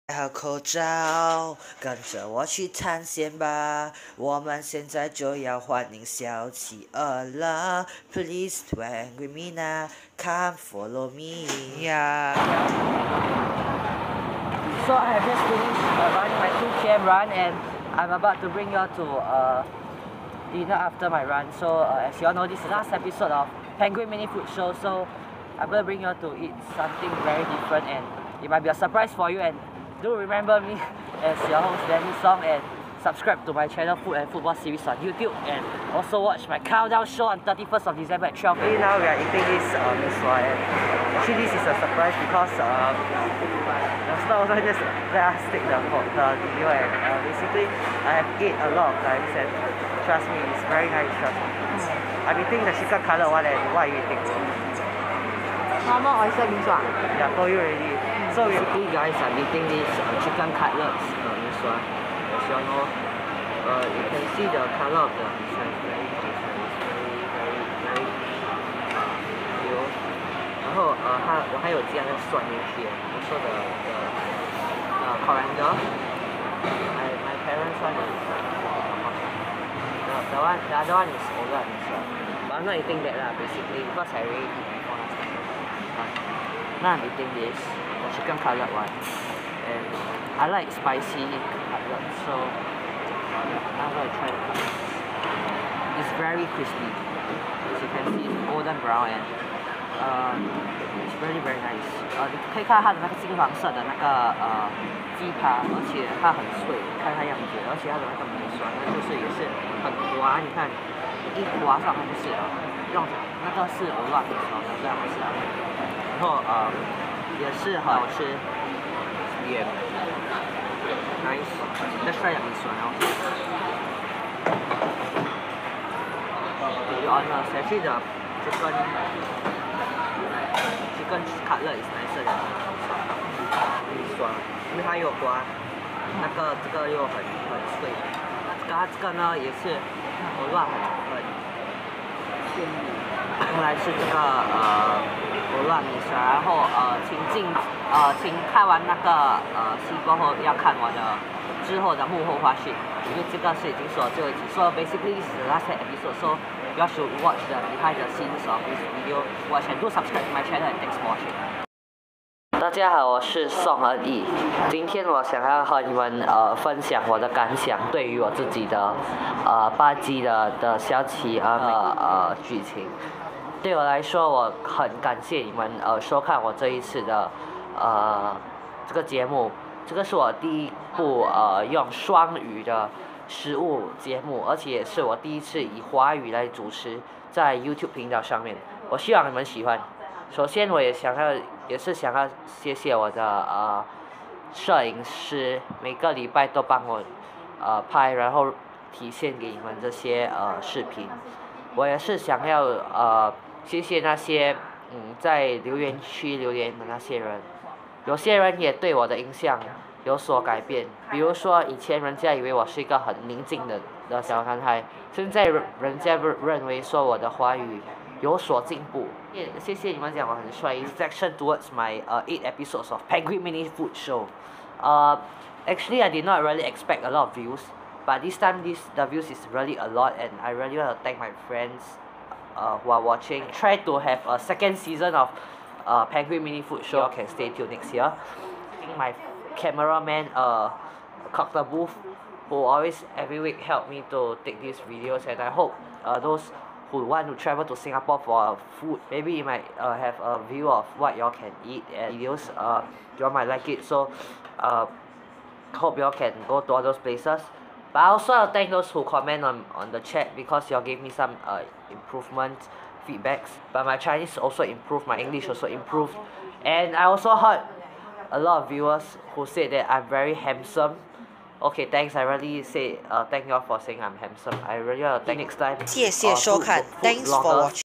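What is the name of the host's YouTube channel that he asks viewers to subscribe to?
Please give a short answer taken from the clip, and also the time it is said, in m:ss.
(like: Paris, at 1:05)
Food and Football Series, at 0:34.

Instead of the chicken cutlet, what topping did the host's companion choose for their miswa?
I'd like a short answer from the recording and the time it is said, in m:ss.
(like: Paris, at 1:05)
Oyster, at 0:56.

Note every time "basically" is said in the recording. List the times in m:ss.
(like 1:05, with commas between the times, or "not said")
0:47, 0:58, 1:23, 2:34.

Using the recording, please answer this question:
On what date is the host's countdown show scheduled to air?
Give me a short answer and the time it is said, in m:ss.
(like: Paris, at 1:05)
31st of December, at 0:37.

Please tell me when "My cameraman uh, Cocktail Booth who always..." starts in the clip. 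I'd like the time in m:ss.
3:58.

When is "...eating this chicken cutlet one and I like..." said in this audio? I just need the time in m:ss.
1:27.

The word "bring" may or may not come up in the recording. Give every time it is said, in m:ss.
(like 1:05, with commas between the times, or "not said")
0:18, 0:25.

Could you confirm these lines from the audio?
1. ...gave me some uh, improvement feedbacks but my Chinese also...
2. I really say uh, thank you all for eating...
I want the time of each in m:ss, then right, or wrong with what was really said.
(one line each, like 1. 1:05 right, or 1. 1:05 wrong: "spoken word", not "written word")
1. 4:20 right
2. 4:32 wrong: "saying", not "eating".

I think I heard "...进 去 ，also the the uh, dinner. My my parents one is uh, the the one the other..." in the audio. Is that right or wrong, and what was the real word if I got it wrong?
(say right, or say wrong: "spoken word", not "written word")
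wrong: "coriander", not "dinner".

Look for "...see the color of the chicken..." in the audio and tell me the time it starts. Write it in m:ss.
1:04.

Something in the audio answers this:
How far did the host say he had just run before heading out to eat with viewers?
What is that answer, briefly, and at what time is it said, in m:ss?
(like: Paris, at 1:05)
2 km, at 0:16.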